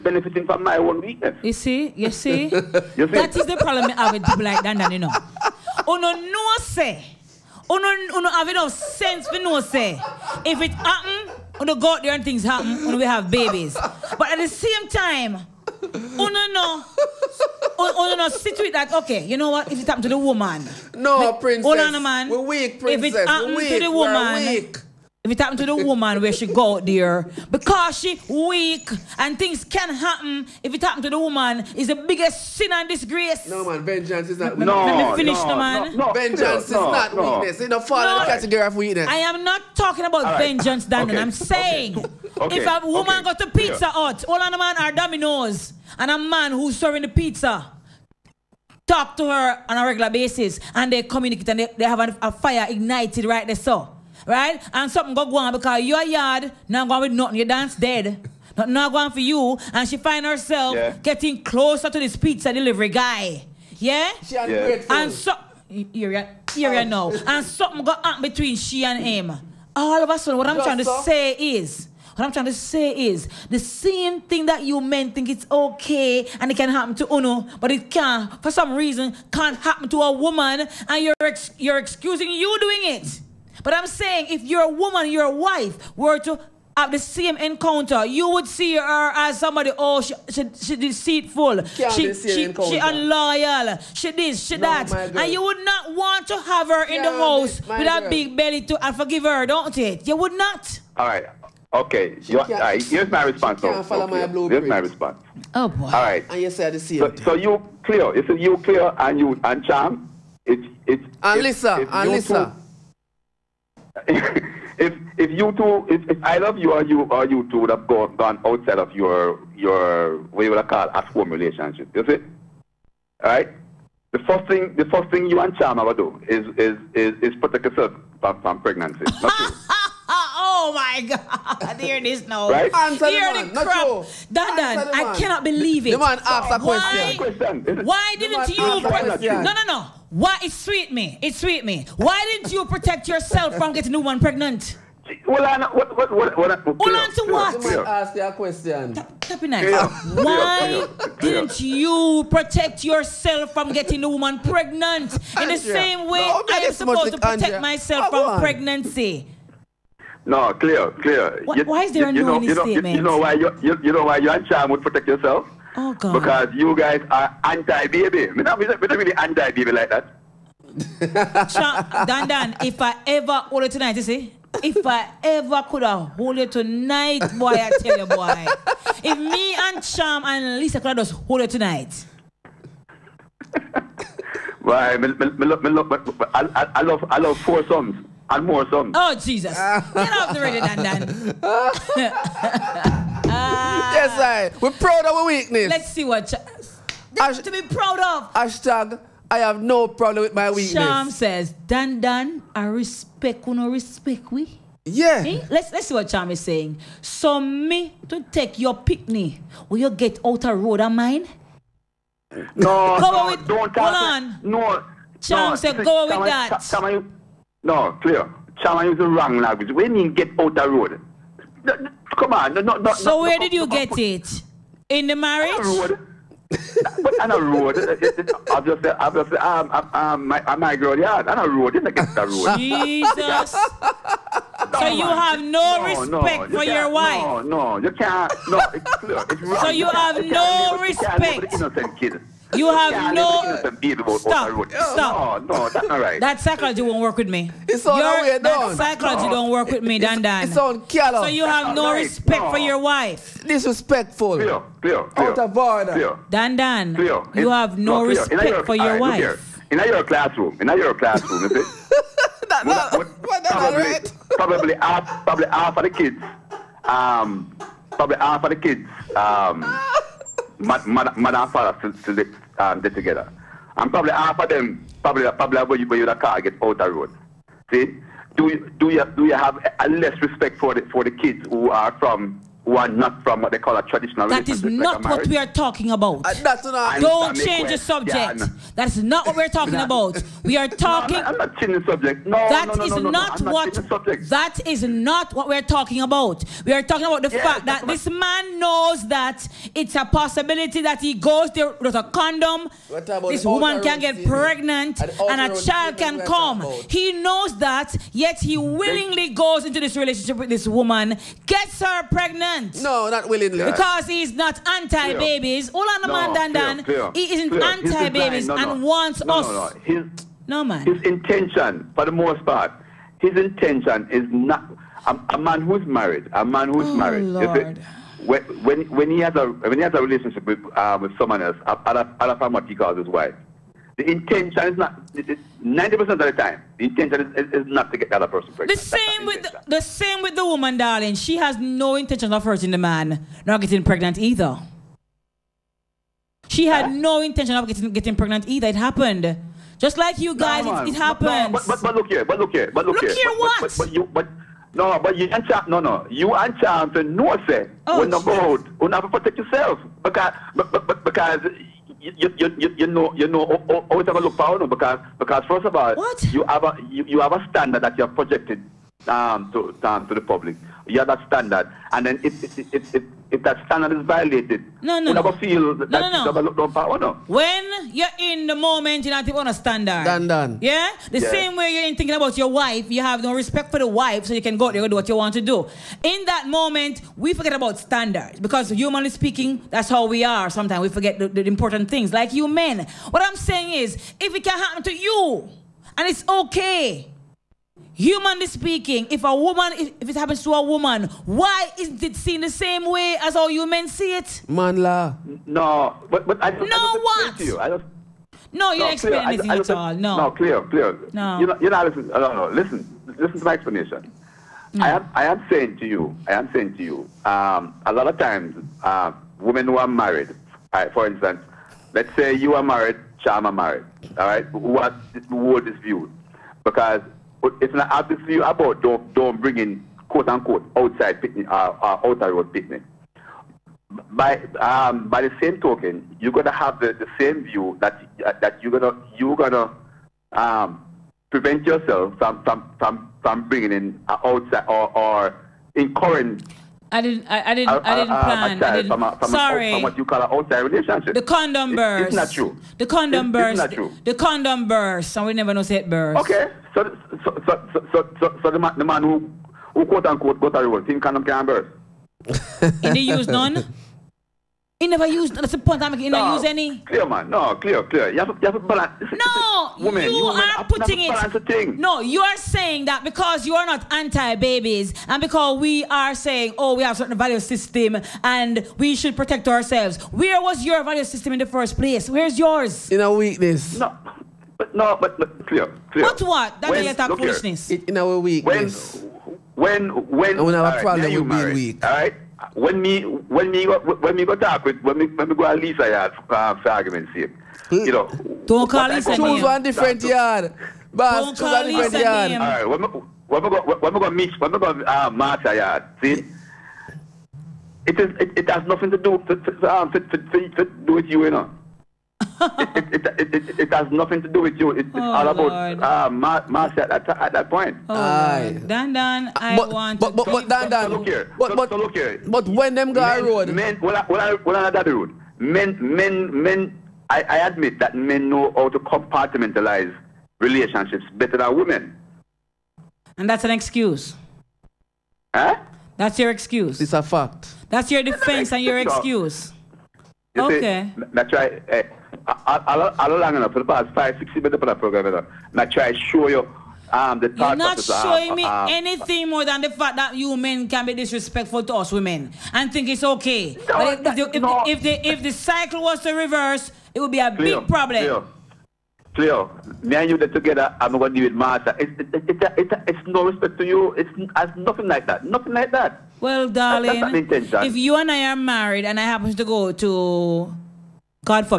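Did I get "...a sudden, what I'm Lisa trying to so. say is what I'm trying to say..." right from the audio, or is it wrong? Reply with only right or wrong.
wrong.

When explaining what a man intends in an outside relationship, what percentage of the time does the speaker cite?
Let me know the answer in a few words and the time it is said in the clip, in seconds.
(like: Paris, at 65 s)
90, at 335 s.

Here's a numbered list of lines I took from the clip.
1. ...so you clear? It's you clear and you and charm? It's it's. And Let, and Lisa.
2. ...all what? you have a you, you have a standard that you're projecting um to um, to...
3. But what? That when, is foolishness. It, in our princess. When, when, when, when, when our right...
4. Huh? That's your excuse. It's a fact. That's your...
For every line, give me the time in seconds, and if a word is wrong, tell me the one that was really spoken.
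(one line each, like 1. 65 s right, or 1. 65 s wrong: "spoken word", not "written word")
1. 107 s wrong: "Lisa", not "Let"
2. 365 s right
3. 486 s wrong: "weakness", not "princess"
4. 535 s right.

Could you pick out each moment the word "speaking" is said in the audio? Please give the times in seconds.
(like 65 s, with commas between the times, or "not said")
389 s, 398 s.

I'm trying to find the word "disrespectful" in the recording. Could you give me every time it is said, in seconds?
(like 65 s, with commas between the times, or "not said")
253 s, 550 s.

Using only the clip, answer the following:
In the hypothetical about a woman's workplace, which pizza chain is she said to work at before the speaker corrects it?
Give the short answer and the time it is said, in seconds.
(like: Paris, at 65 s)
Pizza Hut, at 43 s.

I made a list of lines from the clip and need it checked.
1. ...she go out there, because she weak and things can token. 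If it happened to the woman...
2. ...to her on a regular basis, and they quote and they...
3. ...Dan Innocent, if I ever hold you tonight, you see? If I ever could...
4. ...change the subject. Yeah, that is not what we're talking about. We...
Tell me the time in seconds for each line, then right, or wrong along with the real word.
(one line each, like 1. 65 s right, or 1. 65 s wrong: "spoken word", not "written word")
1. 26 s wrong: "happen", not "token"
2. 49 s wrong: "communicate", not "quote"
3. 172 s wrong: "Dan", not "Innocent"
4. 287 s right.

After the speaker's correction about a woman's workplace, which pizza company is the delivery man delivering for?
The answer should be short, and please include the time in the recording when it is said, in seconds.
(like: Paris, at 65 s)
Domino's, at 44 s.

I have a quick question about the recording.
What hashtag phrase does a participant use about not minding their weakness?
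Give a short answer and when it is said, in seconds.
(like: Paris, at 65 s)
I have no problem with my weakness, at 198 s.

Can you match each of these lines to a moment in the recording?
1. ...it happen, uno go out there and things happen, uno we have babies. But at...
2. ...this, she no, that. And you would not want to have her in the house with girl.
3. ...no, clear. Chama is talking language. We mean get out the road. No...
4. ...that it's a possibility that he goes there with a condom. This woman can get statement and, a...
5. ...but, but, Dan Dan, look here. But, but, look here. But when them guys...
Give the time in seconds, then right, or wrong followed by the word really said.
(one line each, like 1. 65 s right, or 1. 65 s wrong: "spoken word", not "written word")
1. 10 s right
2. 94 s right
3. 217 s wrong: "wrong", not "talking"
4. 299 s wrong: "pregnant", not "statement"
5. 520 s right.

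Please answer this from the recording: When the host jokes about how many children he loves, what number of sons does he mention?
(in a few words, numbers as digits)
4.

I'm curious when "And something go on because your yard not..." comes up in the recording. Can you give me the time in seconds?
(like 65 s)
54 s.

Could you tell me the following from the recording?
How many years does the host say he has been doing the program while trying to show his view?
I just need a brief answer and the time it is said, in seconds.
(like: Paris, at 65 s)
5 or 6 years, at 543 s.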